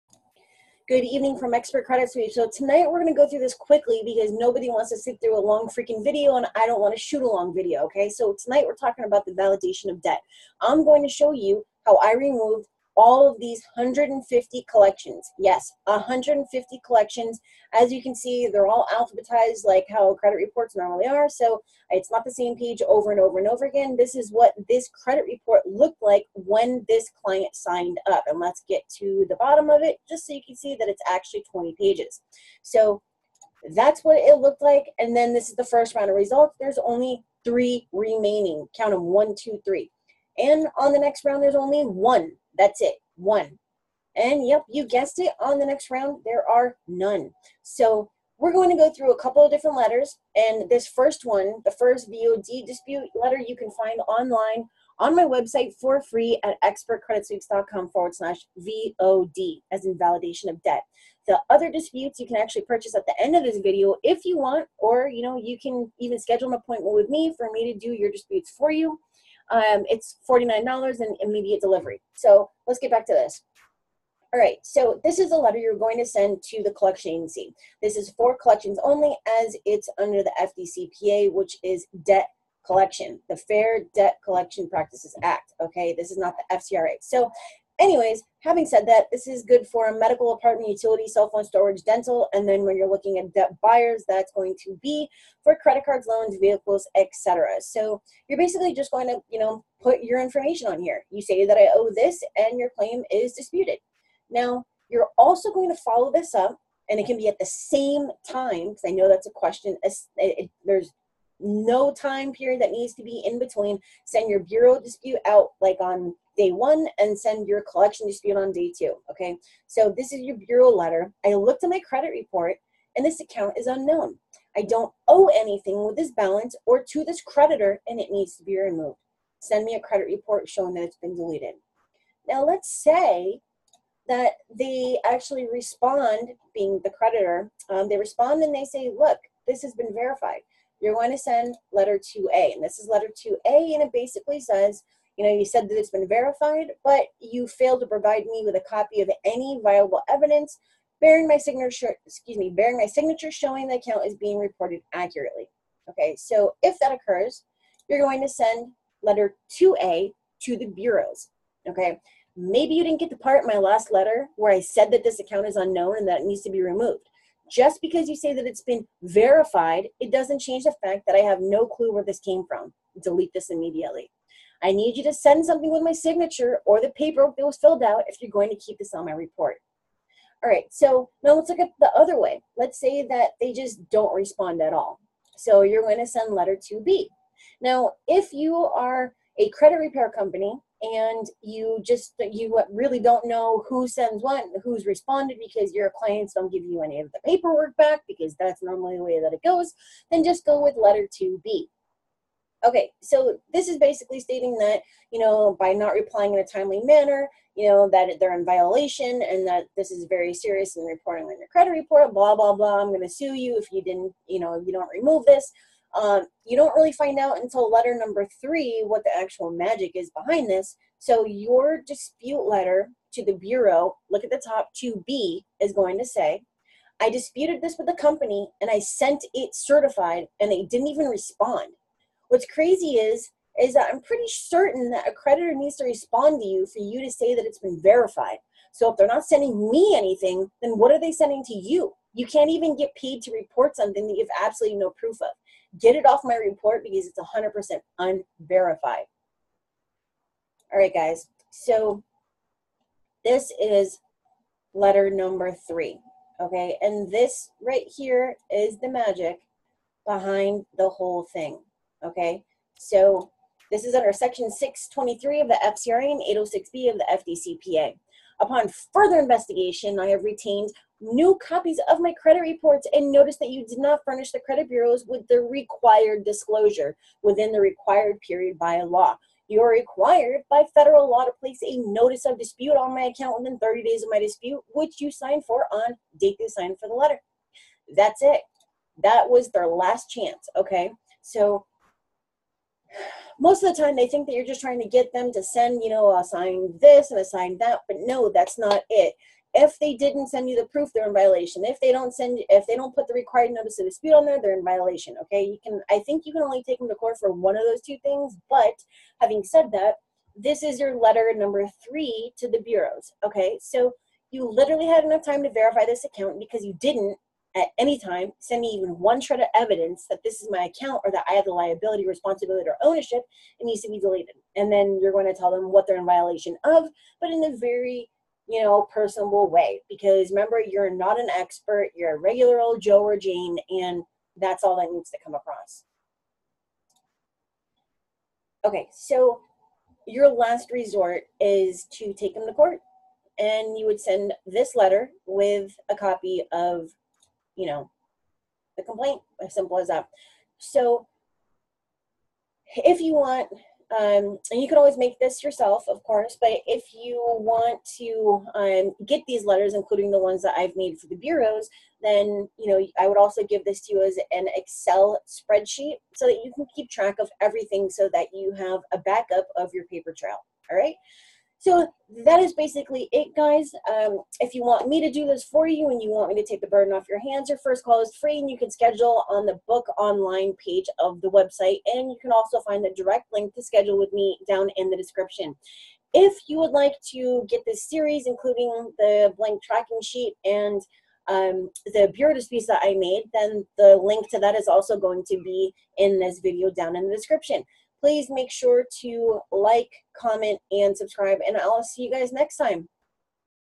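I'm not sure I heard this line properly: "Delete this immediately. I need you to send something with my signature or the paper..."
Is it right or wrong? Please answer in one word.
right.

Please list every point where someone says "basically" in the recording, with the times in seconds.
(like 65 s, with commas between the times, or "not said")
98 s, 143 s, 203 s, 372 s.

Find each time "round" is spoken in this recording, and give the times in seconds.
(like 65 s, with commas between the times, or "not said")
35 s, 41 s, 45 s.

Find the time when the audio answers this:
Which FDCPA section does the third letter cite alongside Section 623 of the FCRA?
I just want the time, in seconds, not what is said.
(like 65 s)
266 s.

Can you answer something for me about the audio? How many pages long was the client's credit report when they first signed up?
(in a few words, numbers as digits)
20.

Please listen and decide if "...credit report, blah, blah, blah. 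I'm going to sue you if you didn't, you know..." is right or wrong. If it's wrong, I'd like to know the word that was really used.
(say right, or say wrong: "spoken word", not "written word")
right.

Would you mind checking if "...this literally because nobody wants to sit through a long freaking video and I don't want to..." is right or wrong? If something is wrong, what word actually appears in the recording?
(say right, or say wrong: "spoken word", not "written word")
wrong: "quickly", not "literally".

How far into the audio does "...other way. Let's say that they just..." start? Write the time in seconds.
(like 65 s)
181 s.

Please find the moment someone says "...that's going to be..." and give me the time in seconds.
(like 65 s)
94 s.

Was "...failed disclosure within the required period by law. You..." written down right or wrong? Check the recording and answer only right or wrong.
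wrong.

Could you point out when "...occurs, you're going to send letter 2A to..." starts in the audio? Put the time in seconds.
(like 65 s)
156 s.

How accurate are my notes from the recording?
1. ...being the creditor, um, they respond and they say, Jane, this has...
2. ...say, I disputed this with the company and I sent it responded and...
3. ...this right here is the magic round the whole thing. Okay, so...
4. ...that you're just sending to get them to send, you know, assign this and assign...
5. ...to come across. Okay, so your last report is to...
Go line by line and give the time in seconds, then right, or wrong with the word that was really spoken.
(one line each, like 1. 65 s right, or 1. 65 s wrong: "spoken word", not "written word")
1. 136 s wrong: "Look", not "Jane"
2. 226 s wrong: "certified", not "responded"
3. 257 s wrong: "behind", not "round"
4. 294 s wrong: "trying", not "sending"
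5. 335 s wrong: "resort", not "report".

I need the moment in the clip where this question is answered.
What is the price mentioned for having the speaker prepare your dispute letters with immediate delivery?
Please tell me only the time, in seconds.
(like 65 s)
70 s.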